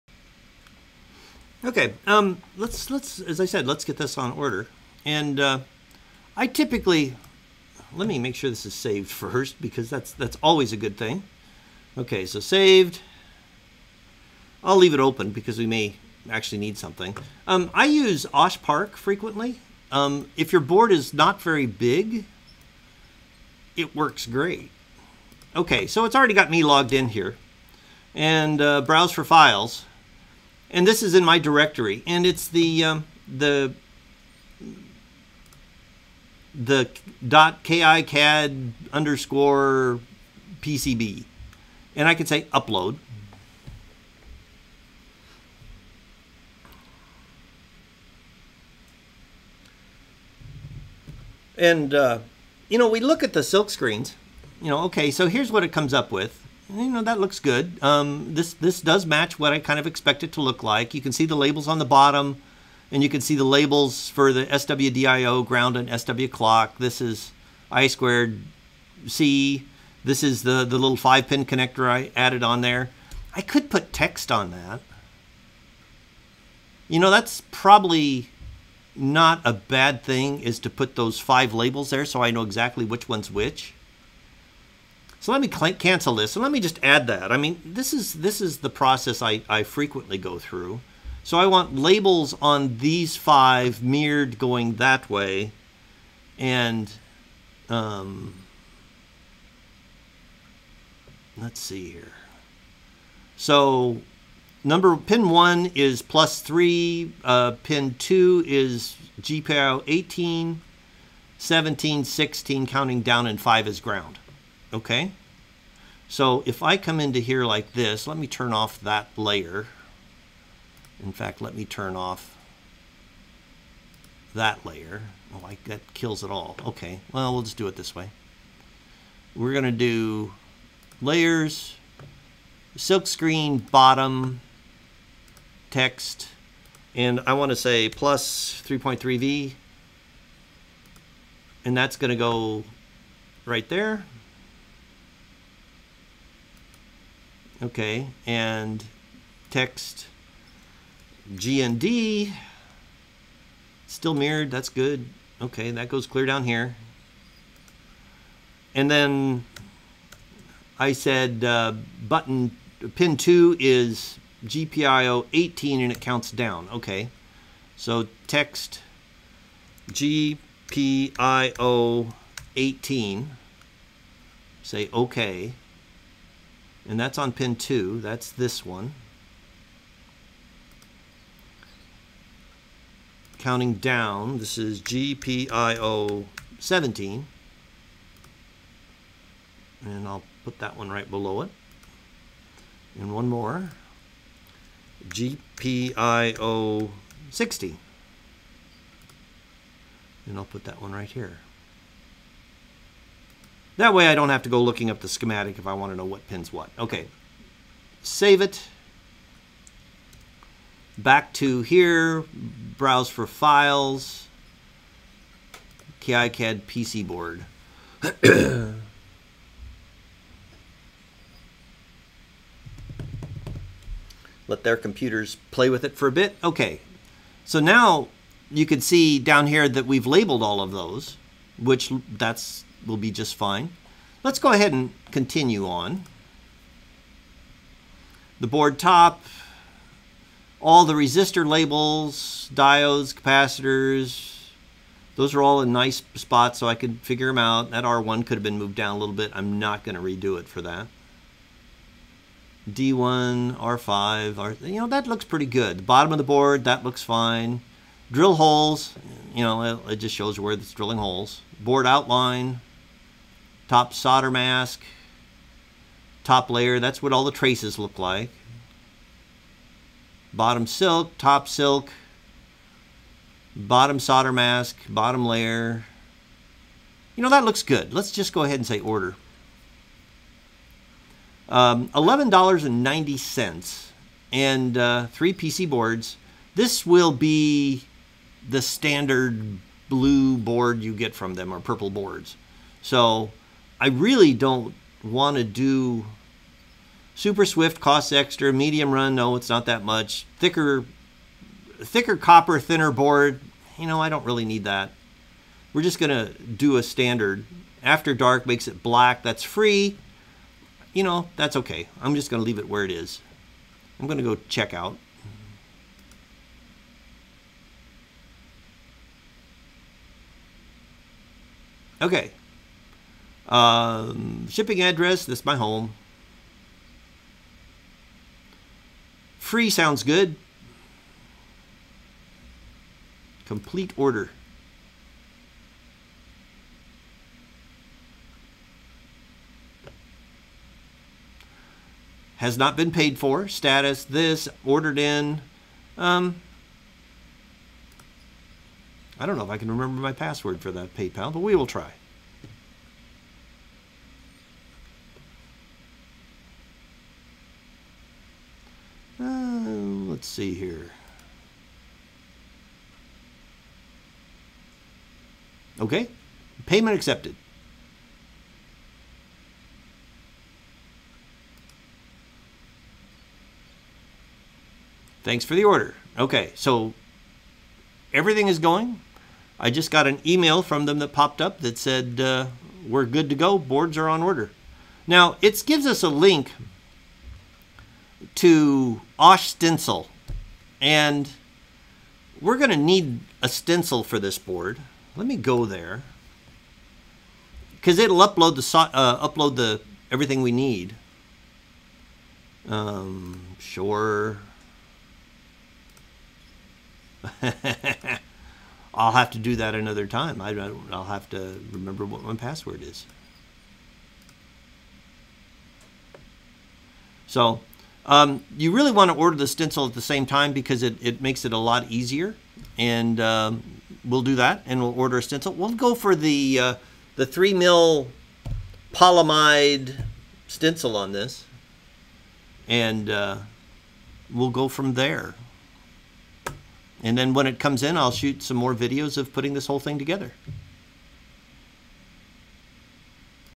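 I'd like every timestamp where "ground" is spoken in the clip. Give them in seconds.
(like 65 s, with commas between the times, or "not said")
65 s, 113 s.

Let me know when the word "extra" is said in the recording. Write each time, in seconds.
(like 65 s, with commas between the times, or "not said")
298 s.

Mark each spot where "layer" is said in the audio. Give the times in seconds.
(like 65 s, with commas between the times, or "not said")
119 s, 124 s, 131 s, 266 s, 275 s.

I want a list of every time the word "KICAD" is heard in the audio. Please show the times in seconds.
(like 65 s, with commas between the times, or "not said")
37 s, 216 s.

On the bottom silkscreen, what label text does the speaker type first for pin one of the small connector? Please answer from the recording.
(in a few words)
+3.3V.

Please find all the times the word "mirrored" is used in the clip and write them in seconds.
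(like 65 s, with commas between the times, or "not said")
93 s, 154 s.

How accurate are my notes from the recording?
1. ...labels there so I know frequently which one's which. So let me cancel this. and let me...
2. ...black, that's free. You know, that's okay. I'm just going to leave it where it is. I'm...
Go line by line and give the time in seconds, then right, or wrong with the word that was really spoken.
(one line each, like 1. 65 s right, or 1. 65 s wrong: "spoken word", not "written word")
1. 81 s wrong: "exactly", not "frequently"
2. 308 s right.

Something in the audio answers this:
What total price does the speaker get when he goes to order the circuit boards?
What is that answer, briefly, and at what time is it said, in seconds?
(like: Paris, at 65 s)
$11.90, at 281 s.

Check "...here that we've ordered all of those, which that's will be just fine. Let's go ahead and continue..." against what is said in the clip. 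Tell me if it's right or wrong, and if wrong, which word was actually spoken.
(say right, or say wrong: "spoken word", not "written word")
wrong: "labeled", not "ordered".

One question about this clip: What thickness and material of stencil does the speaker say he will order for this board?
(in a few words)
3 mil polyimide.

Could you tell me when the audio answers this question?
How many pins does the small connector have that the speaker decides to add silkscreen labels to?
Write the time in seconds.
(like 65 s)
70 s.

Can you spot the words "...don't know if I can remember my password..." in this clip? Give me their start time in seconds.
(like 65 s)
349 s.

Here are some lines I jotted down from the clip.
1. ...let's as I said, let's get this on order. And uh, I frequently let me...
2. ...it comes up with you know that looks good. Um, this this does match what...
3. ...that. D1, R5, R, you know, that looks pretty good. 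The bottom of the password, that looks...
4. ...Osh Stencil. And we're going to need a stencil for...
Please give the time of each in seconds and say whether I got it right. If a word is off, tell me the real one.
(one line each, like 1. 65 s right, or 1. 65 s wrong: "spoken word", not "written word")
1. 2 s wrong: "typically", not "frequently"
2. 55 s right
3. 250 s wrong: "board", not "password"
4. 389 s right.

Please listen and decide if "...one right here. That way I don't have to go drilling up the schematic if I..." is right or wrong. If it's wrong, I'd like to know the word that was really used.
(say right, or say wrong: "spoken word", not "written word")
wrong: "looking", not "drilling".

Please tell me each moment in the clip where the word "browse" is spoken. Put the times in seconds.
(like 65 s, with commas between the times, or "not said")
28 s, 212 s.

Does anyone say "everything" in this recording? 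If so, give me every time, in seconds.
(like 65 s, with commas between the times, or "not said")
378 s, 400 s.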